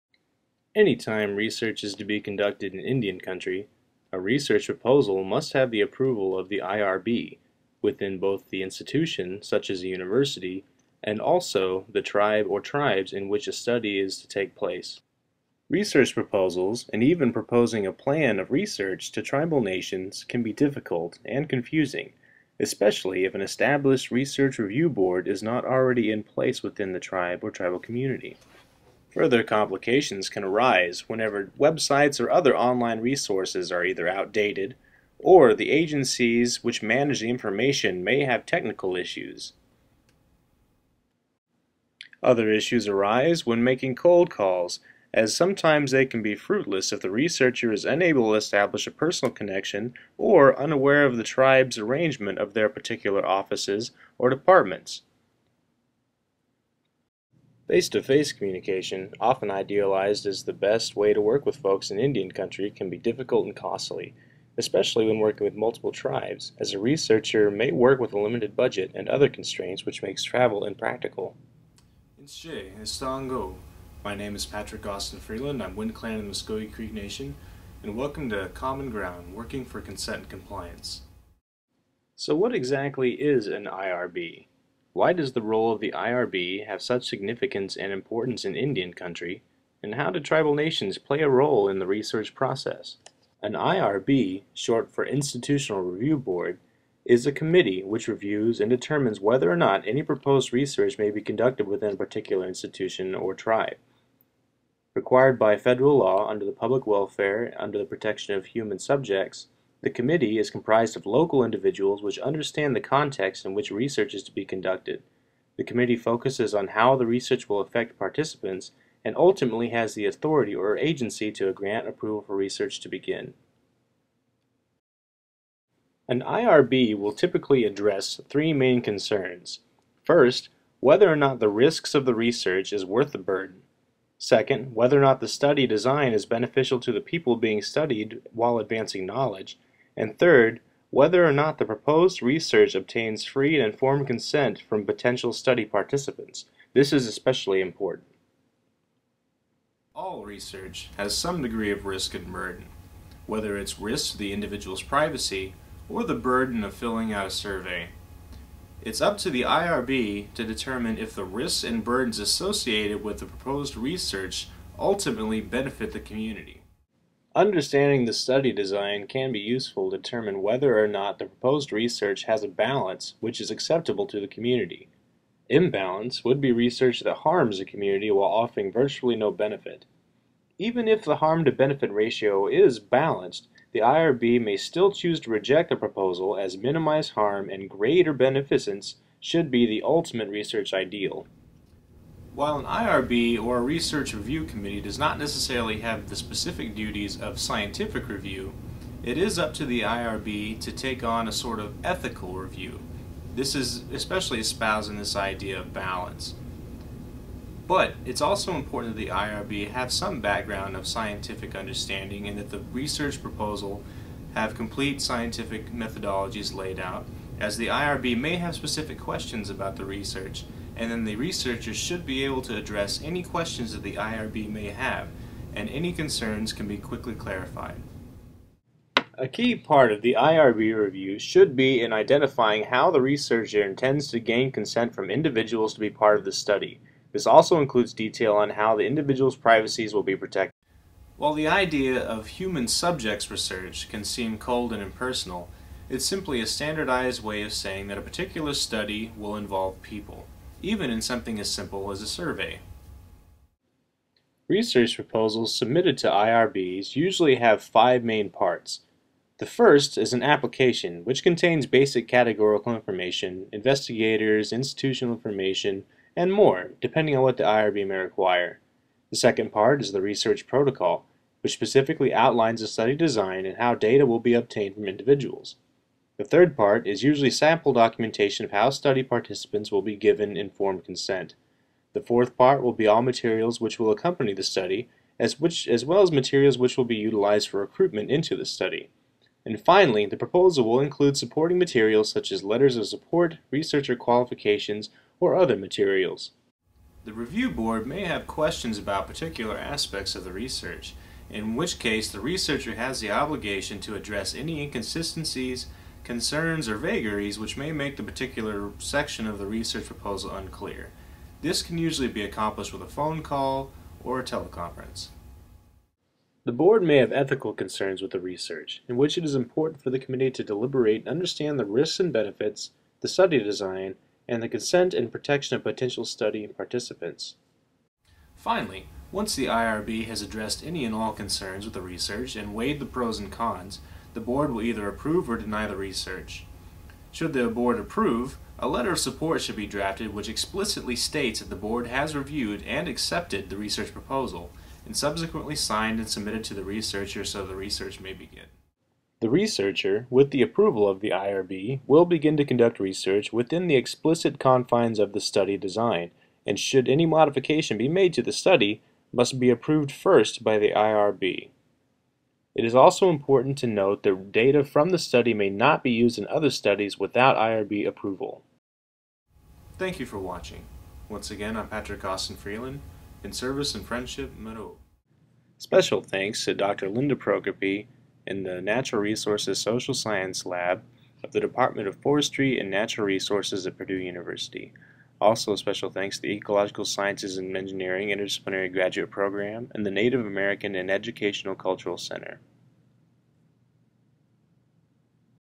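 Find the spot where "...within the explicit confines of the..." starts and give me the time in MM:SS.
05:53.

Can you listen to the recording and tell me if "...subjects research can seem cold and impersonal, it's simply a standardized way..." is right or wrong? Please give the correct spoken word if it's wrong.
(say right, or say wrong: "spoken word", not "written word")
right.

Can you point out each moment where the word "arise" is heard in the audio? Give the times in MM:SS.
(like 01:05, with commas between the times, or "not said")
00:30, 00:42.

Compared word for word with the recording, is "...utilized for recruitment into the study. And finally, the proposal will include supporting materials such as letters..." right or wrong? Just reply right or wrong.
right.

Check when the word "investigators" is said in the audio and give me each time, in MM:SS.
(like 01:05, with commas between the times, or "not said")
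04:23.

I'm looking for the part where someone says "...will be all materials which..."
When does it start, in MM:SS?
04:42.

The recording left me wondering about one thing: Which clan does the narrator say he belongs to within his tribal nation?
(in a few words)
Wind Clan.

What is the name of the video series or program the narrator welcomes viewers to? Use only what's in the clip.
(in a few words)
Common Ground.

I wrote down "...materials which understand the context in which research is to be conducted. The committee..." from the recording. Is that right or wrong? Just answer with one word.
wrong.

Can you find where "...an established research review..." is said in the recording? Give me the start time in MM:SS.
00:23.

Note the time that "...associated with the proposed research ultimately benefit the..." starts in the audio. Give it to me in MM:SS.
02:42.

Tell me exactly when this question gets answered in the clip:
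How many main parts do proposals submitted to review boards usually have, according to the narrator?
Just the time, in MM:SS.
04:17.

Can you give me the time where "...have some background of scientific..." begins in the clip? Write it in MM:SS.
03:29.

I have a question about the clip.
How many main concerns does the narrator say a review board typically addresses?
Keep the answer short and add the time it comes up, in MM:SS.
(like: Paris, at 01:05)
3, at 02:08.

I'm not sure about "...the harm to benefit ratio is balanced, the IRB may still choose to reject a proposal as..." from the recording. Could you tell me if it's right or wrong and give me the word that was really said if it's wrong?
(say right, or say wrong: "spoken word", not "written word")
right.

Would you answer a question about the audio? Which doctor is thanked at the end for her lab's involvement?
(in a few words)
Linda Prokopy.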